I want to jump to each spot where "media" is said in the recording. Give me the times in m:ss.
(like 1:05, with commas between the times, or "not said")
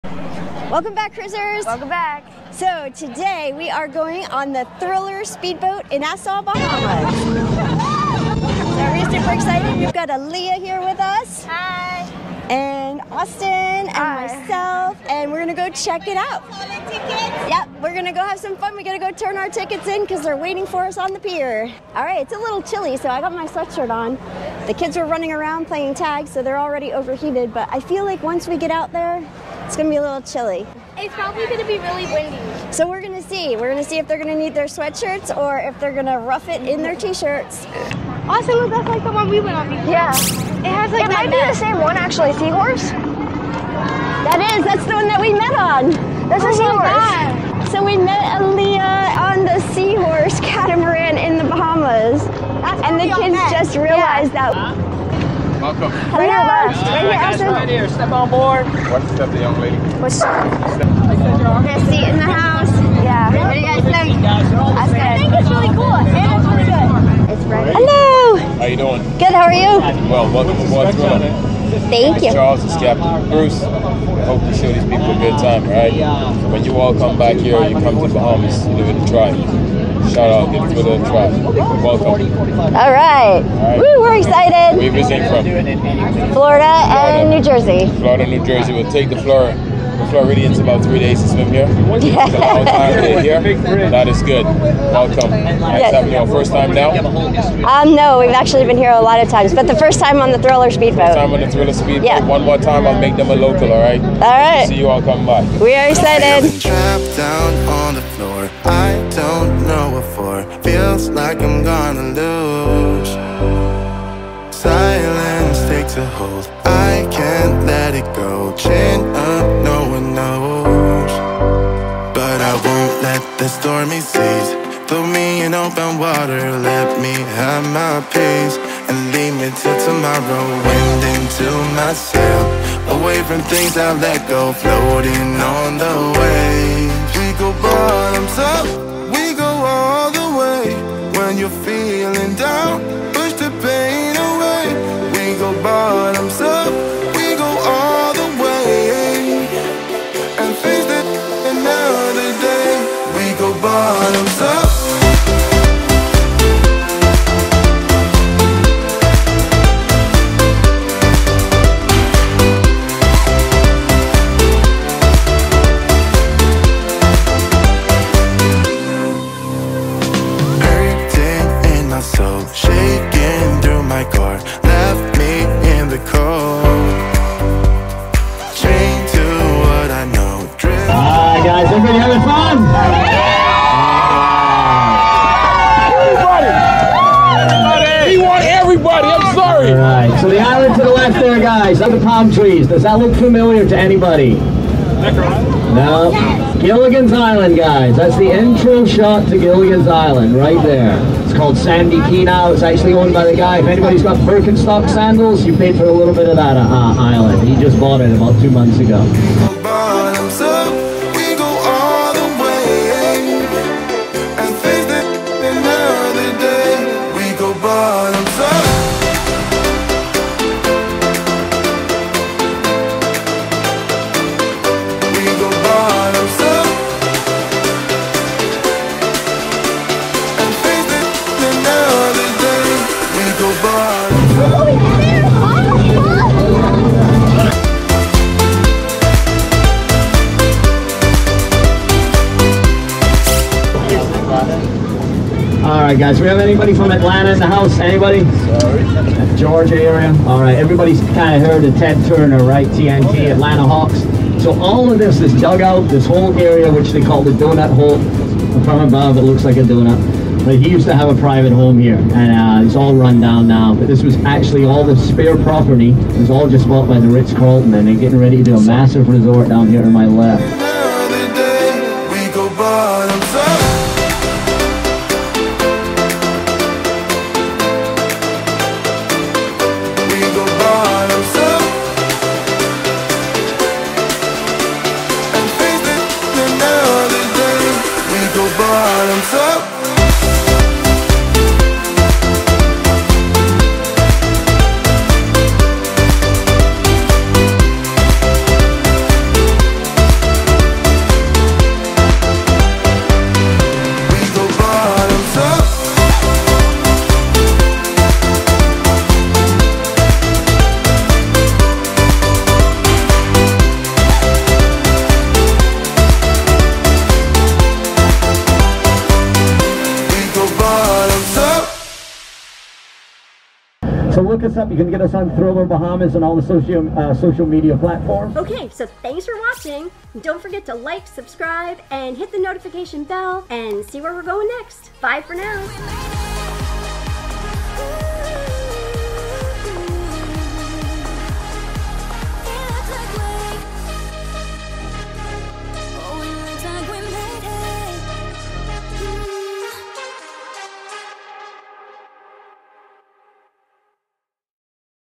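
5:27.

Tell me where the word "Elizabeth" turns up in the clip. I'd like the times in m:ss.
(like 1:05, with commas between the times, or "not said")
not said.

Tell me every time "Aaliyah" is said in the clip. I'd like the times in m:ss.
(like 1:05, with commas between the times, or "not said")
0:10, 0:48.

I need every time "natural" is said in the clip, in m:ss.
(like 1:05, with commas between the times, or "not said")
not said.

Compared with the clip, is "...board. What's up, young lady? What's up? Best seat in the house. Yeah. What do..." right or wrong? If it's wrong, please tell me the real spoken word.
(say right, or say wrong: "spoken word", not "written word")
right.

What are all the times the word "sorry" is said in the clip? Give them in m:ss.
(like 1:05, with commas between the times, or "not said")
3:09, 4:08.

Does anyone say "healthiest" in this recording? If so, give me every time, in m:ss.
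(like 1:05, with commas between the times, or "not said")
not said.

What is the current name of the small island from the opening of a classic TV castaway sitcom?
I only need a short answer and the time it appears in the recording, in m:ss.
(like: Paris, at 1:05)
Sandy Key, at 3:21.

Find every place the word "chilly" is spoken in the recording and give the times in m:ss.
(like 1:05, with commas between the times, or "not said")
0:22, 0:30.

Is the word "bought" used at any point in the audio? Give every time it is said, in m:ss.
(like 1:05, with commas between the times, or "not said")
3:27, 4:26.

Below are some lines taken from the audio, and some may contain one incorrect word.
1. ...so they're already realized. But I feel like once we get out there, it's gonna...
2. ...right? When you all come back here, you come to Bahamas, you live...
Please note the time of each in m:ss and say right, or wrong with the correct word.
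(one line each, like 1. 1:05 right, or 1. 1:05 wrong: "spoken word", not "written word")
1. 0:26 wrong: "overheated", not "realized"
2. 1:15 right.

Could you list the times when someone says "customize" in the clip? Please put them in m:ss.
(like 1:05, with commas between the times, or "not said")
not said.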